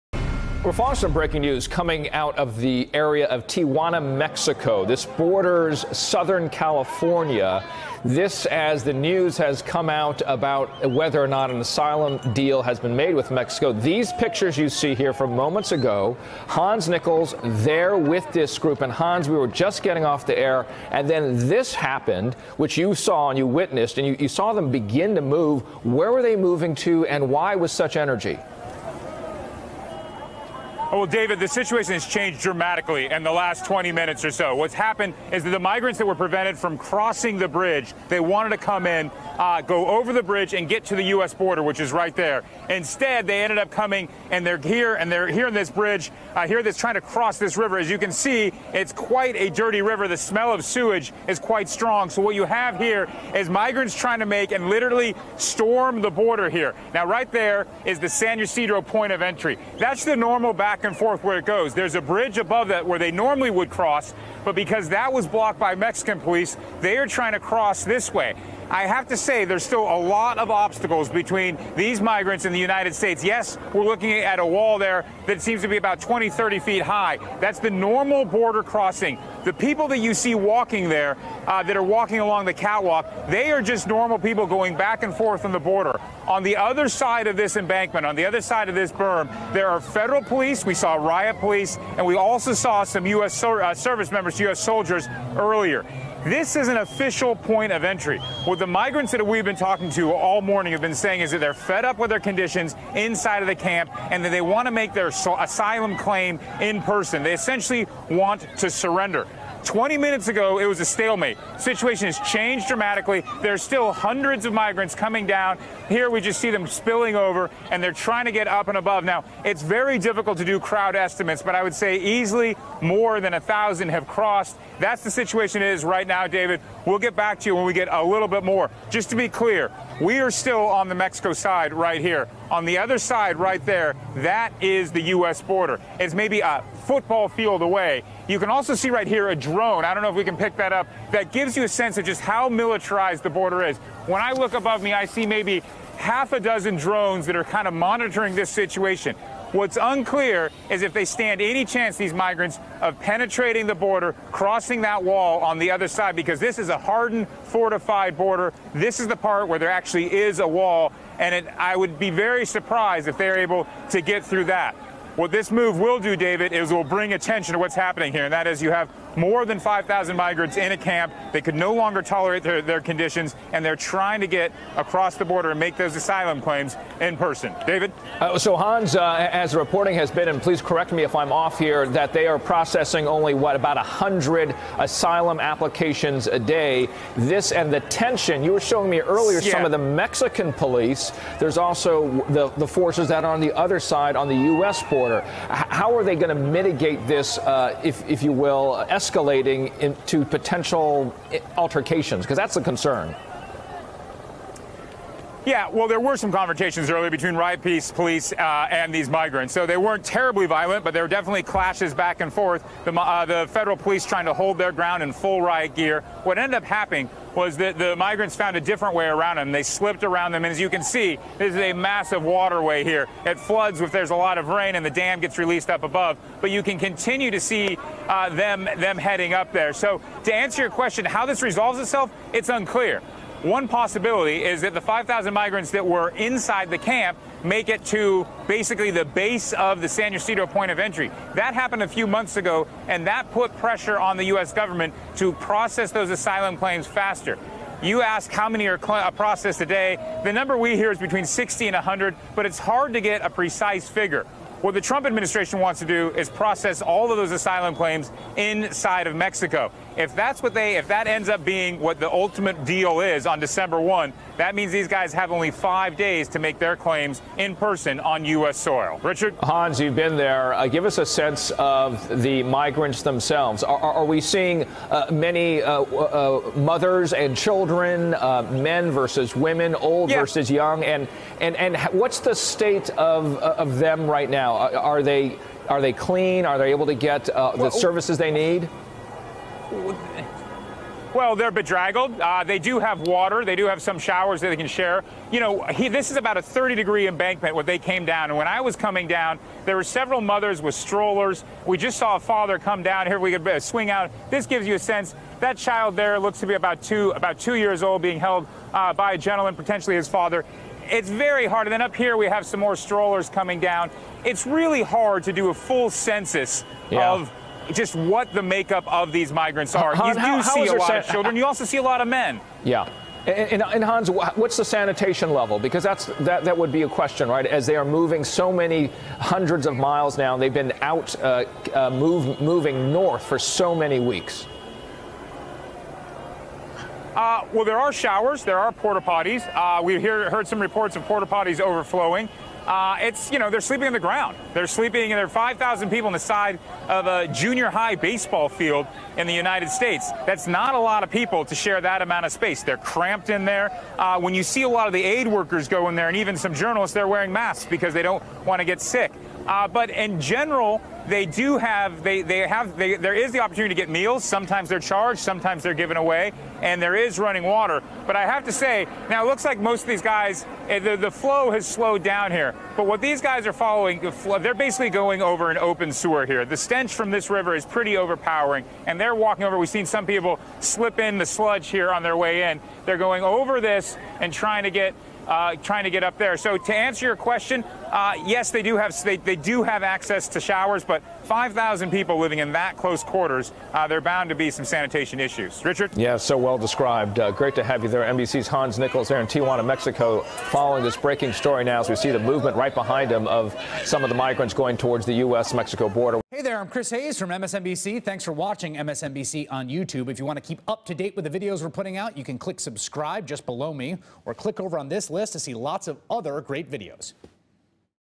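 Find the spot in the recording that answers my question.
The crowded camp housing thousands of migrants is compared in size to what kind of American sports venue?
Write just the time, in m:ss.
5:47.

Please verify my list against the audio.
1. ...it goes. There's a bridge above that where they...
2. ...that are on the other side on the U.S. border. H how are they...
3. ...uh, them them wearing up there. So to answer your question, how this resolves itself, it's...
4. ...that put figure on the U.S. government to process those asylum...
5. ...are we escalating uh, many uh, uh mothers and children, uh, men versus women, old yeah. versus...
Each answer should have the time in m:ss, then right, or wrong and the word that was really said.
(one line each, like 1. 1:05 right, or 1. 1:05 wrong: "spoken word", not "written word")
1. 1:01 right
2. 3:13 right
3. 3:48 wrong: "heading", not "wearing"
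4. 4:03 wrong: "pressure", not "figure"
5. 4:33 wrong: "seeing", not "escalating".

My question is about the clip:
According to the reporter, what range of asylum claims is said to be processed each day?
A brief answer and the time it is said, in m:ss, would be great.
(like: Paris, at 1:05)
60 to 100, at 4:10.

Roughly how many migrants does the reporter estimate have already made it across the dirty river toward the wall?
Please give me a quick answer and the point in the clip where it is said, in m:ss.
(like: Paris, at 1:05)
more than 1,000, at 2:02.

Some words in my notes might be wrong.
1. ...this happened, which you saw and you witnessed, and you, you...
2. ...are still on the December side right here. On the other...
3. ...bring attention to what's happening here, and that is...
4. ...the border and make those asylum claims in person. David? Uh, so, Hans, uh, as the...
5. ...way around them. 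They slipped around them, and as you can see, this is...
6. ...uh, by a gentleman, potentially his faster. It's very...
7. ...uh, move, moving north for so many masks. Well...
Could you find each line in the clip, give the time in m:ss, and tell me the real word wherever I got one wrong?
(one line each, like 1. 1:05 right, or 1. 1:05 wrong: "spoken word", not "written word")
1. 0:21 right
2. 2:10 wrong: "Mexico", not "December"
3. 2:46 right
4. 2:55 right
5. 3:38 right
6. 5:08 wrong: "father", not "faster"
7. 5:31 wrong: "weeks", not "masks".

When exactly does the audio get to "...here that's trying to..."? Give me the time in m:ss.
0:46.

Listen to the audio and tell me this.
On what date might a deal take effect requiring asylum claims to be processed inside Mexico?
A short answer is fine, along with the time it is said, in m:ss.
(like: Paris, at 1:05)
December 1, at 4:23.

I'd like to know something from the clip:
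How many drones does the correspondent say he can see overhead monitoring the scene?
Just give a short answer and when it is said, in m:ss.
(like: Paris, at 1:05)
half a dozen, at 2:25.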